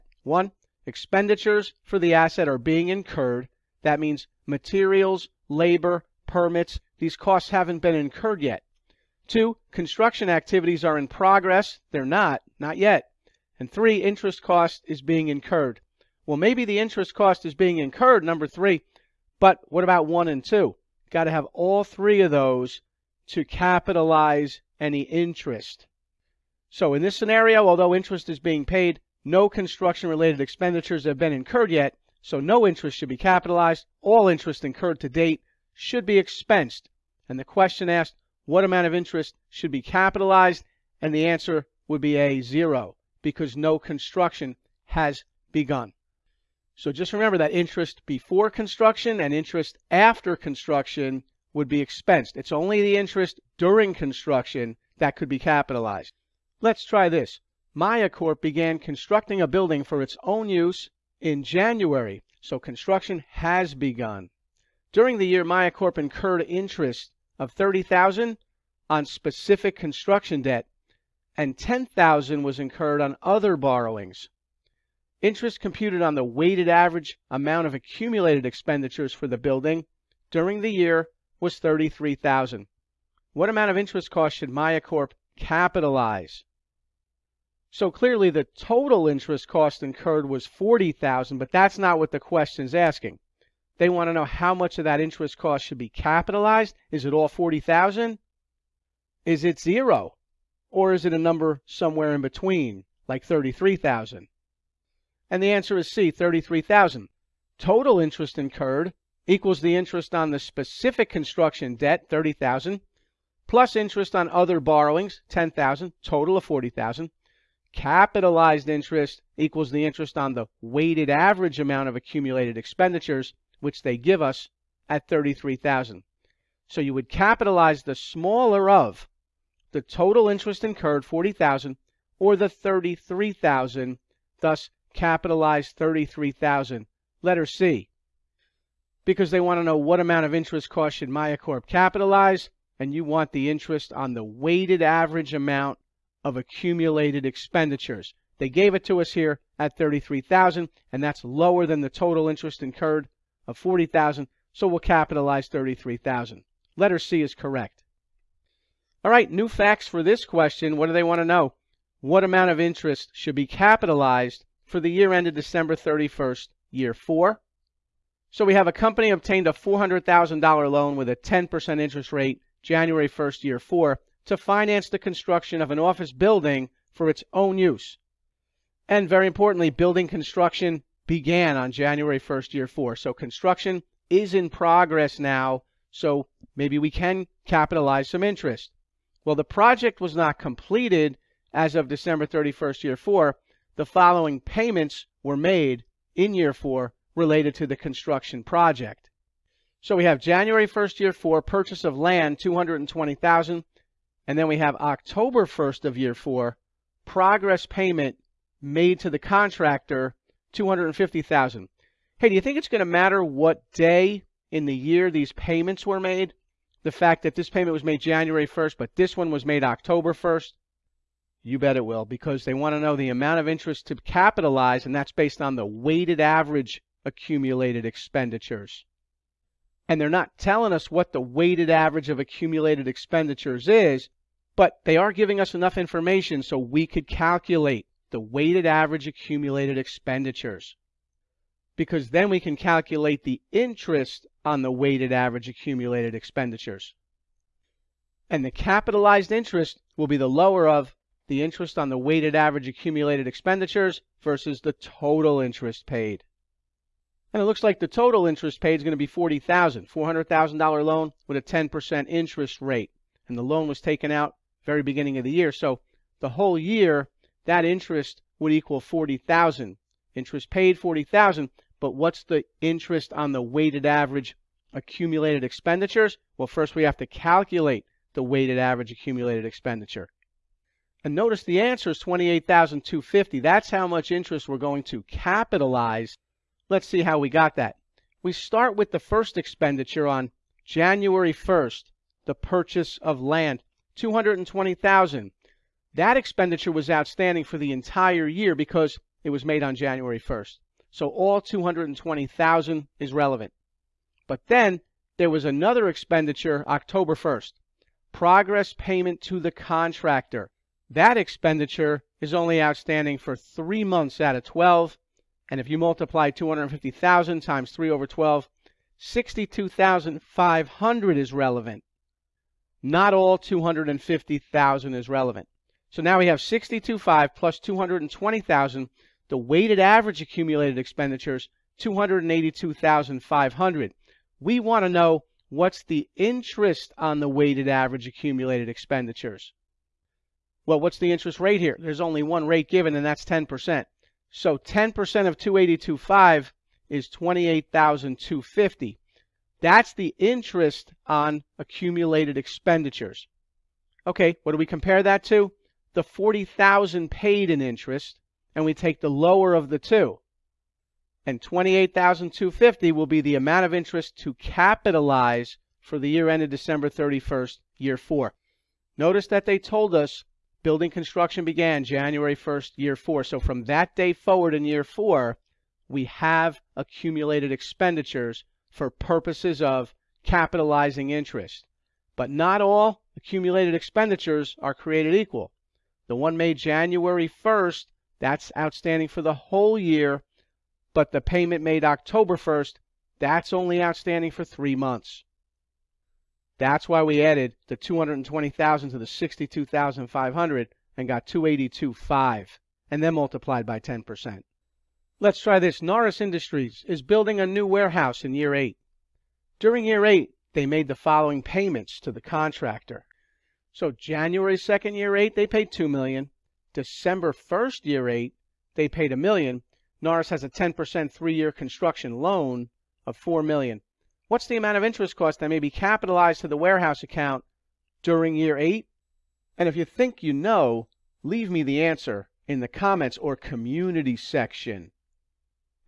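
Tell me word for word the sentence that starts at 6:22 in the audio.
But not all accumulated expenditures are created equal.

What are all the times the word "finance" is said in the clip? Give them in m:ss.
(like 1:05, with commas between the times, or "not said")
2:54.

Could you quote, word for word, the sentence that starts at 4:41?
And notice the answer is 28,250.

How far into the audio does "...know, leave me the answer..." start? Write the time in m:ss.
7:10.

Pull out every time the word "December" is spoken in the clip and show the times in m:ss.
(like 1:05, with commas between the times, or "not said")
2:45, 3:11, 6:06, 6:56.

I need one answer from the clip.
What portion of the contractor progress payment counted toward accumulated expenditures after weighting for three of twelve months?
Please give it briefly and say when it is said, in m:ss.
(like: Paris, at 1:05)
62,500, at 5:18.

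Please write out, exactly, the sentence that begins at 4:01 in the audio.
Because then we can calculate the interest on the weighted average accumulated expenditures.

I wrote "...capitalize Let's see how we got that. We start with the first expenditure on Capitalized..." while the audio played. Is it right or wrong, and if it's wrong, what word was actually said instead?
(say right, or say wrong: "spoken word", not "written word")
wrong: "January", not "Capitalized".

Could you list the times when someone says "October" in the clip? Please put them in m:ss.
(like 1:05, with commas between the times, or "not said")
3:24, 3:39, 5:06, 6:31.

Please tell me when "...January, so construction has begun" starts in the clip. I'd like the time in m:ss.
1:01.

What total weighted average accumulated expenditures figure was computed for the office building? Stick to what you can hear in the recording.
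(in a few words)
282,500.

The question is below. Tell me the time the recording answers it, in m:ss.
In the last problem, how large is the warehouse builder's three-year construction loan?
7:03.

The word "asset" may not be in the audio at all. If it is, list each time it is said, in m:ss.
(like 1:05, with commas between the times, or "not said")
0:02.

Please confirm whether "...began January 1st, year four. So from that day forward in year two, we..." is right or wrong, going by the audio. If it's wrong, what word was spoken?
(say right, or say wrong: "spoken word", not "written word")
wrong: "four", not "two".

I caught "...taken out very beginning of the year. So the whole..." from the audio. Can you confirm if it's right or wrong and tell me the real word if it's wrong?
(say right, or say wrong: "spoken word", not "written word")
right.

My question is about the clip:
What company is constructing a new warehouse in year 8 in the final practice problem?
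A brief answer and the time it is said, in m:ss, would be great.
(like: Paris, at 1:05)
Norris Industries, at 6:45.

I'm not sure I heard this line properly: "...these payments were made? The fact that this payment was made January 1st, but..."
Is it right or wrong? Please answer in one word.
right.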